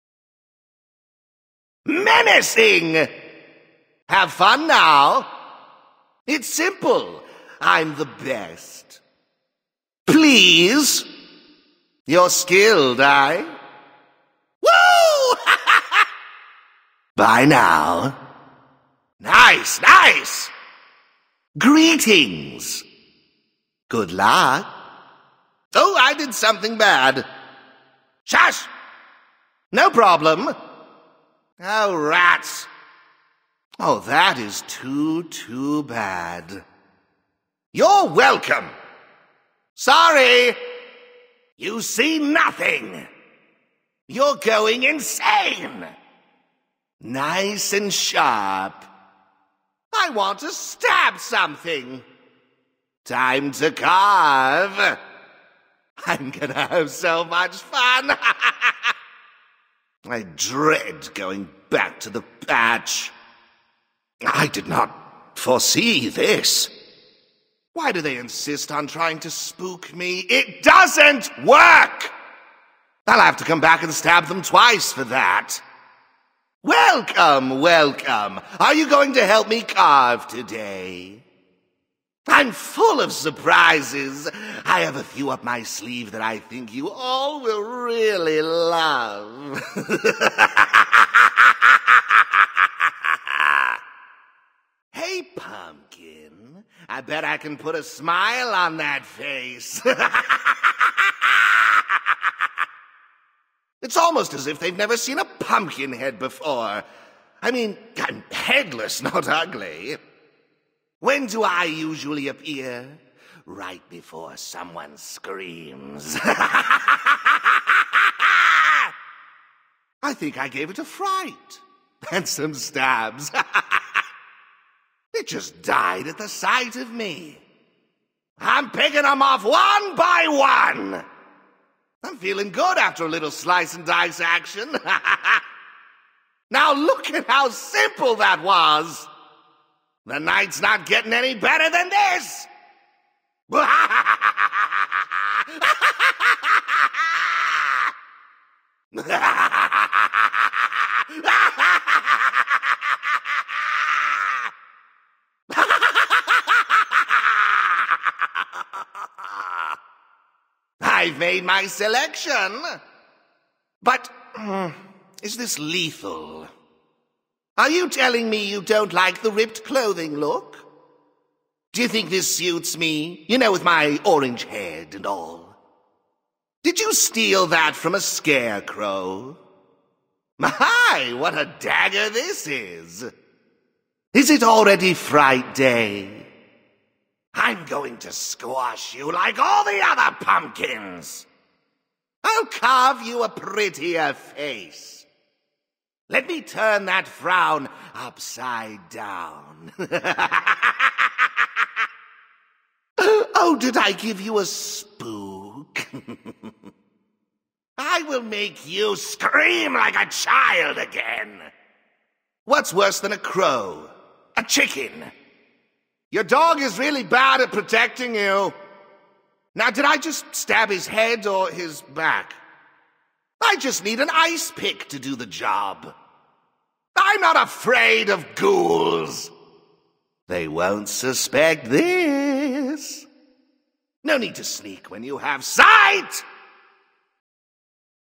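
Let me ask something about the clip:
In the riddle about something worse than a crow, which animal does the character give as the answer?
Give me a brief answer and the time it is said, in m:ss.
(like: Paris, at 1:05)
A chicken, at 3:34.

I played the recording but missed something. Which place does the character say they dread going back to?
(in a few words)
the patch.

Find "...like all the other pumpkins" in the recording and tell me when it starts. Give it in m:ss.
3:09.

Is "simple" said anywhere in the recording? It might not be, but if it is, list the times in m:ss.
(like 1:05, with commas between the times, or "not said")
0:06, 2:17.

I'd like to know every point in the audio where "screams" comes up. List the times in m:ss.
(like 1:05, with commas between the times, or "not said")
1:54, 3:28.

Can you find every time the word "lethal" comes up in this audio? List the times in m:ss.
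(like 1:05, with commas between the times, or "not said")
2:45.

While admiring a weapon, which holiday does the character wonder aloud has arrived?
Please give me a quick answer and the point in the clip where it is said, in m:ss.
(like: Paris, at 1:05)
Fright Day, at 3:04.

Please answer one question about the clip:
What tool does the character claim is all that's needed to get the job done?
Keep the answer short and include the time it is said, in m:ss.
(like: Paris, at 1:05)
An ice pick, at 3:44.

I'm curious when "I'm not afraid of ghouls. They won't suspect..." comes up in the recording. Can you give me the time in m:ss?
3:47.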